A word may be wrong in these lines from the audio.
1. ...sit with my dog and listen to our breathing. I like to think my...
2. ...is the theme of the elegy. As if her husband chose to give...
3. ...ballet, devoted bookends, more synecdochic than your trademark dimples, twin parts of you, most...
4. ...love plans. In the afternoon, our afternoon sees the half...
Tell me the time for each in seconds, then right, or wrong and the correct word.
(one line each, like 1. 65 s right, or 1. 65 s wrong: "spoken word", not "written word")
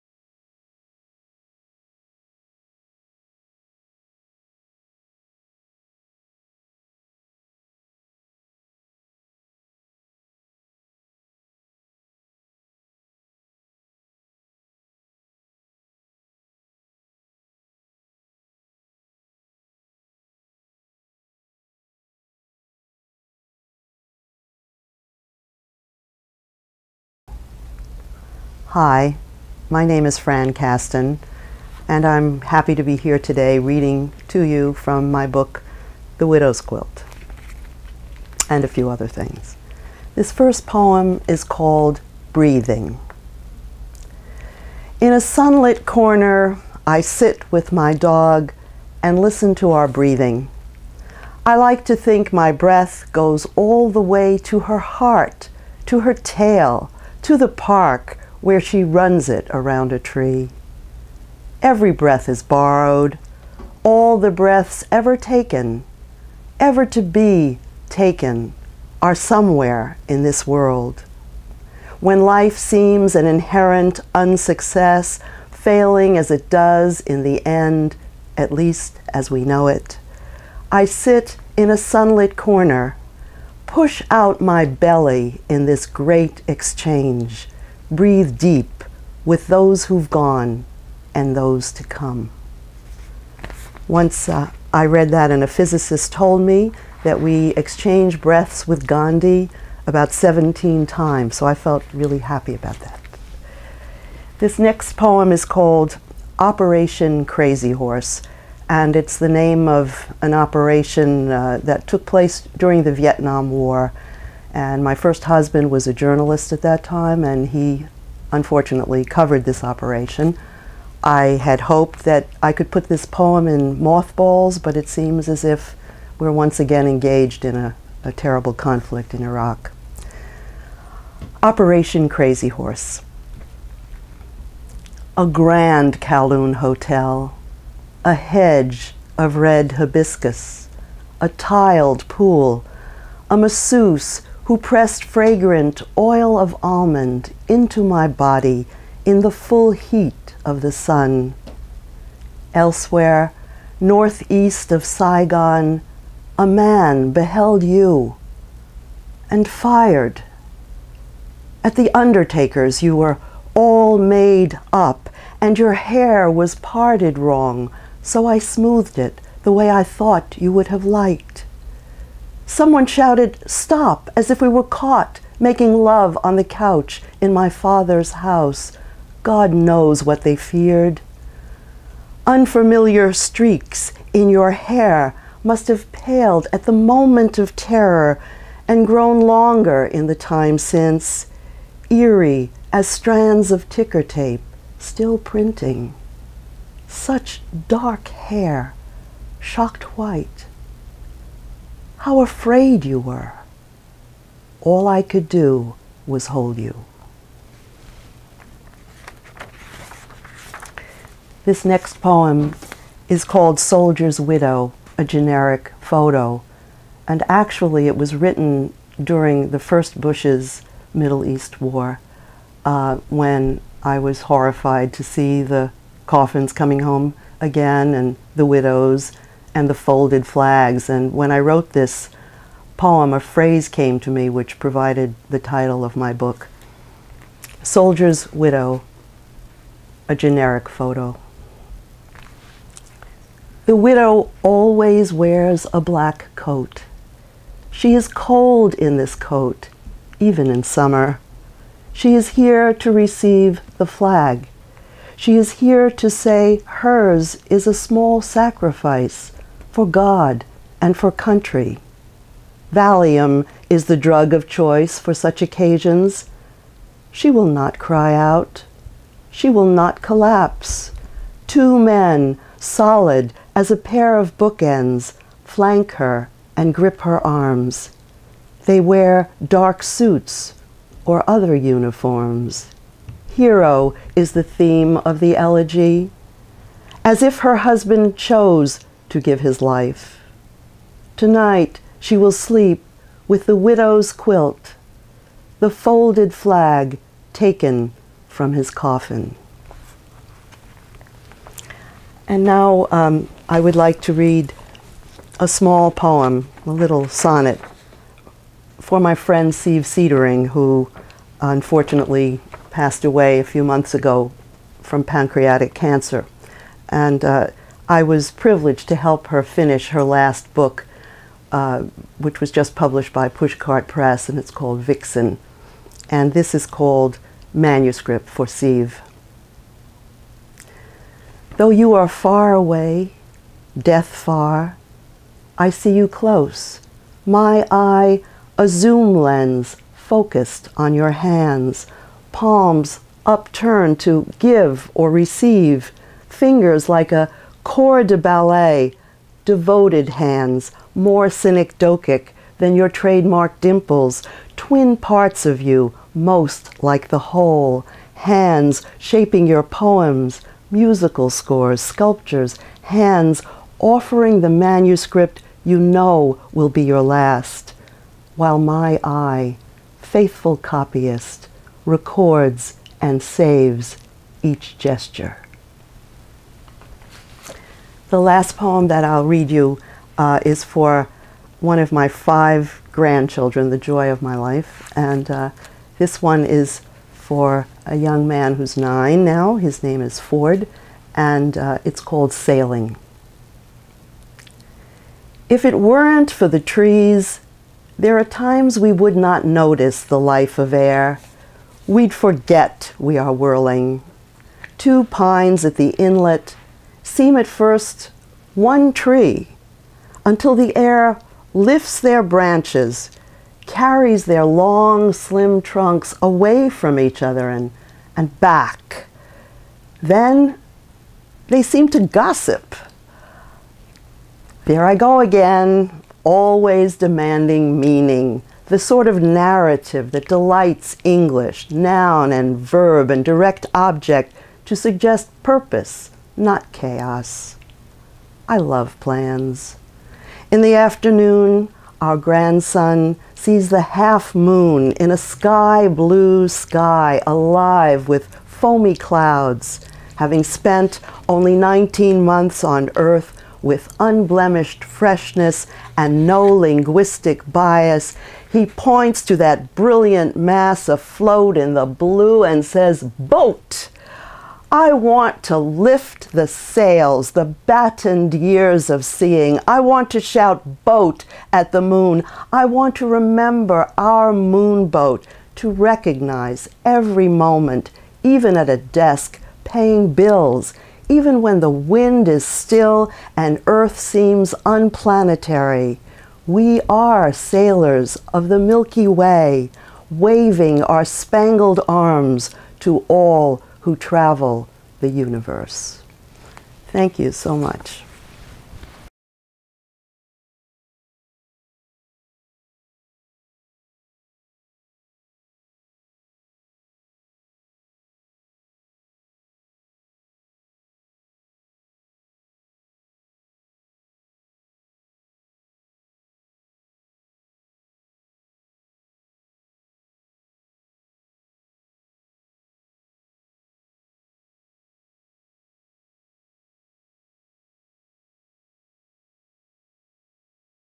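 1. 47 s right
2. 284 s right
3. 348 s wrong: "hands", not "bookends"
4. 438 s wrong: "grandson", not "afternoon".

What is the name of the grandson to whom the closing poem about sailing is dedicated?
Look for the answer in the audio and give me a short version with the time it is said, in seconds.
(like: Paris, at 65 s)
Ford, at 390 s.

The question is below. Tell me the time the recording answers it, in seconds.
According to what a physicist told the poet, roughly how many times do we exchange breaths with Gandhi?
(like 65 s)
100 s.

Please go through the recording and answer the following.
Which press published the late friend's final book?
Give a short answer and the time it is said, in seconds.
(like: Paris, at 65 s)
Pushcart Press, at 323 s.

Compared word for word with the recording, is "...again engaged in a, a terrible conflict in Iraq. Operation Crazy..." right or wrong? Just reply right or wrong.
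right.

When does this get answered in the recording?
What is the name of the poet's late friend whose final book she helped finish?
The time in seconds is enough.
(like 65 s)
309 s.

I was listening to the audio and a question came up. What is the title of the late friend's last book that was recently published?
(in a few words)
Vixen.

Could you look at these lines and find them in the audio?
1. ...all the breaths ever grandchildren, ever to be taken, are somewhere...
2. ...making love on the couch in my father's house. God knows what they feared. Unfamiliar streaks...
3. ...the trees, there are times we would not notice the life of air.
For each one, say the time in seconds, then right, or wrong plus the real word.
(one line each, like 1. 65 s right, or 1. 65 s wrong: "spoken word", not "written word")
1. 63 s wrong: "taken", not "grandchildren"
2. 175 s right
3. 396 s right.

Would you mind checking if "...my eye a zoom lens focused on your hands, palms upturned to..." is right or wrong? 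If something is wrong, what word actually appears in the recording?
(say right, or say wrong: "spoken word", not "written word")
right.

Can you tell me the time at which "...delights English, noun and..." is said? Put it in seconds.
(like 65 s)
430 s.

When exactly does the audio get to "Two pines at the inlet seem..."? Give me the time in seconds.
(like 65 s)
404 s.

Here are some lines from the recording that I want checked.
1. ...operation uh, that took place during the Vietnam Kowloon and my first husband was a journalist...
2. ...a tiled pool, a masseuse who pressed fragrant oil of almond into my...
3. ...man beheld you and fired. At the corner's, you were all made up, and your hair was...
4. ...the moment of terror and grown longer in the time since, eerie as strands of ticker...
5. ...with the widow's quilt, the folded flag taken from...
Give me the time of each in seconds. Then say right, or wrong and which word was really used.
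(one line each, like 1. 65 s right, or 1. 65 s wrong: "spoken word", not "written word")
1. 110 s wrong: "War", not "Kowloon"
2. 141 s right
3. 156 s wrong: "undertaker", not "corner"
4. 186 s right
5. 293 s right.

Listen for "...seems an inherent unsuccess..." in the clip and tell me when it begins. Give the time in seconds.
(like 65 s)
72 s.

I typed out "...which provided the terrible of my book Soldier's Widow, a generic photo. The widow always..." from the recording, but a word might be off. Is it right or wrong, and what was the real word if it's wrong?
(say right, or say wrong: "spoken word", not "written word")
wrong: "title", not "terrible".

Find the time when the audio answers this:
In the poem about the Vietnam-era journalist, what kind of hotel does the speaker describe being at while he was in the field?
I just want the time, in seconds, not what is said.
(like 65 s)
136 s.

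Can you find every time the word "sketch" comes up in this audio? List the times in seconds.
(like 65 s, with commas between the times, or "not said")
not said.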